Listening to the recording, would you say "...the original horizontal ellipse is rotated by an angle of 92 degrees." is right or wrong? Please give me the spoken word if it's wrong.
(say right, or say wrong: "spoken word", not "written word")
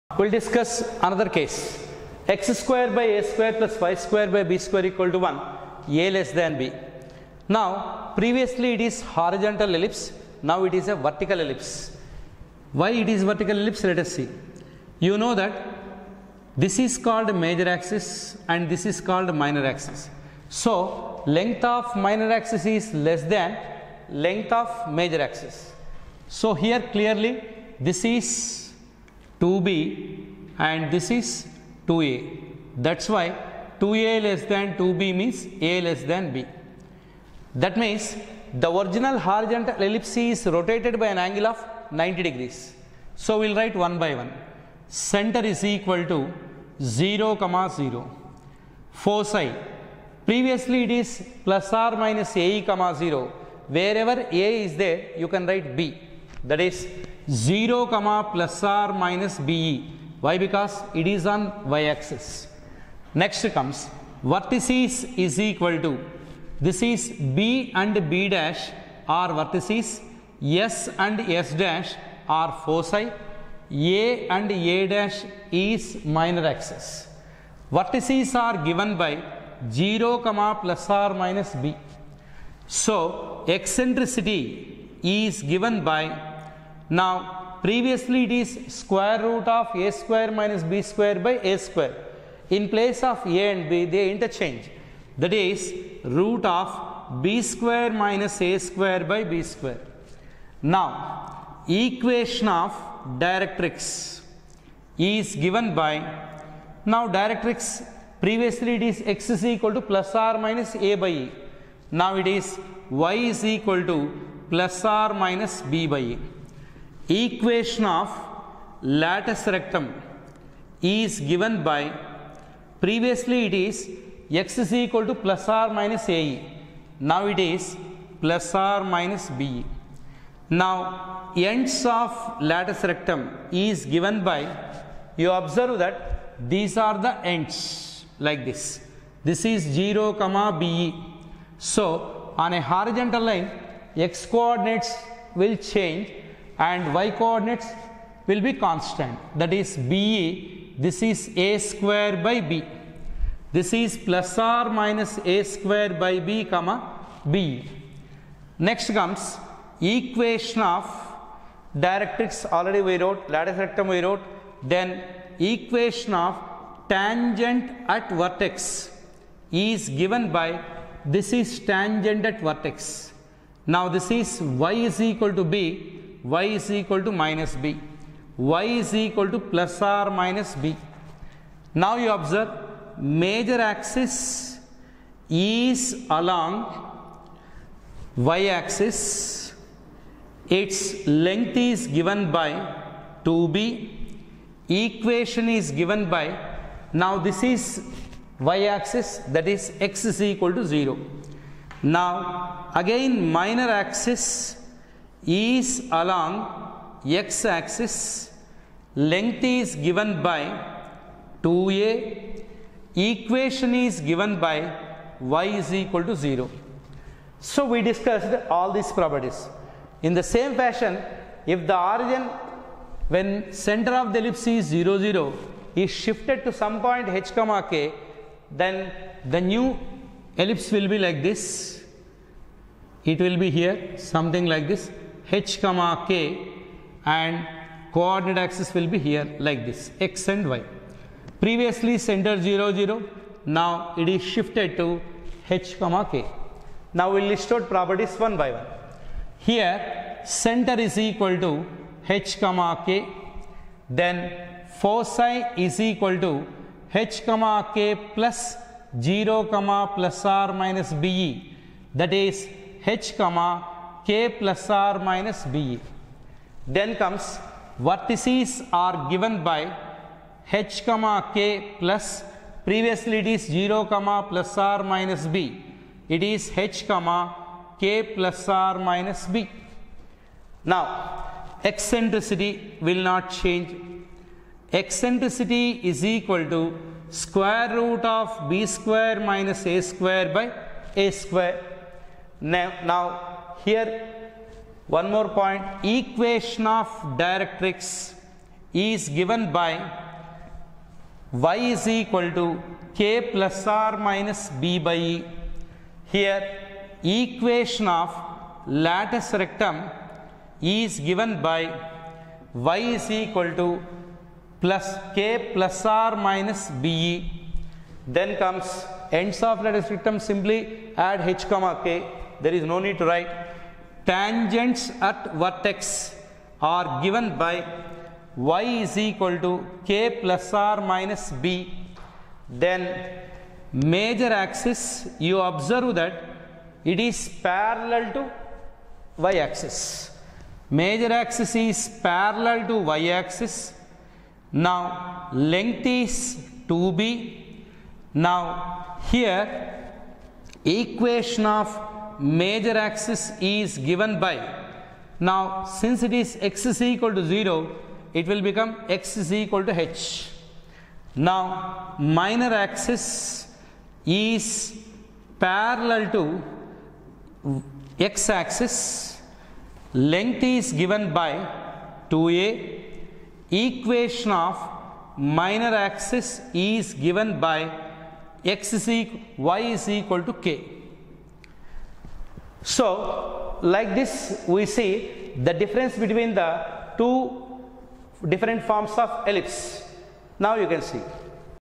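wrong: "90", not "92".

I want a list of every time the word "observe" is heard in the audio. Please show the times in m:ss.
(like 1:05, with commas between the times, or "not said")
2:15, 3:02, 5:35.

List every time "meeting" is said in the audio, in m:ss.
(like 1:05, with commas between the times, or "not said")
not said.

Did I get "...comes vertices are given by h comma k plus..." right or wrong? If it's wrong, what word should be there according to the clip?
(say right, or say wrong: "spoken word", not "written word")
right.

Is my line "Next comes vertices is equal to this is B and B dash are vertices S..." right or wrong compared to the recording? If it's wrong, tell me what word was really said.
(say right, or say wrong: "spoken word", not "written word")
right.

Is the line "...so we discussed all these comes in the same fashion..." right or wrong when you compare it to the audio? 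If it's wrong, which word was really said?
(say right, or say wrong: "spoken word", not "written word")
wrong: "properties", not "comes".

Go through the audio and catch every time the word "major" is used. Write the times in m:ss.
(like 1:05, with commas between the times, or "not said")
0:17, 0:25, 3:02, 5:33, 5:40, 5:52.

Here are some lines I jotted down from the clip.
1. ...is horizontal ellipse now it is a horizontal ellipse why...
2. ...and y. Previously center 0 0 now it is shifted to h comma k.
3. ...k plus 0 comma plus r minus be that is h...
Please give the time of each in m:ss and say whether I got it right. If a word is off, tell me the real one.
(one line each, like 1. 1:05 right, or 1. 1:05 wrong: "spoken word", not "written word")
1. 0:08 wrong: "vertical", not "horizontal"
2. 4:00 right
3. 4:17 right.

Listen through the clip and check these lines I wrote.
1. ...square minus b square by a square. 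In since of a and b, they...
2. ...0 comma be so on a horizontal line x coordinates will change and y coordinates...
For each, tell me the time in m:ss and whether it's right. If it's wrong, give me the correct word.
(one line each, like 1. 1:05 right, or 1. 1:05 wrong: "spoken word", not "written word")
1. 1:29 wrong: "place", not "since"
2. 2:19 right.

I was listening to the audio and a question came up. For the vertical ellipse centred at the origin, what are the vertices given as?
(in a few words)
(0, ±b).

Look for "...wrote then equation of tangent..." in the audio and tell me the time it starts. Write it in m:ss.
2:44.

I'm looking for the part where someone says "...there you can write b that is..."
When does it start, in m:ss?
0:54.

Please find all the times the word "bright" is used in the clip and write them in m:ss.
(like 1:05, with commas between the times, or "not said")
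not said.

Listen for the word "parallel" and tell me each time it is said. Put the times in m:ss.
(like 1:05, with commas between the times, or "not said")
5:37, 5:42, 6:05.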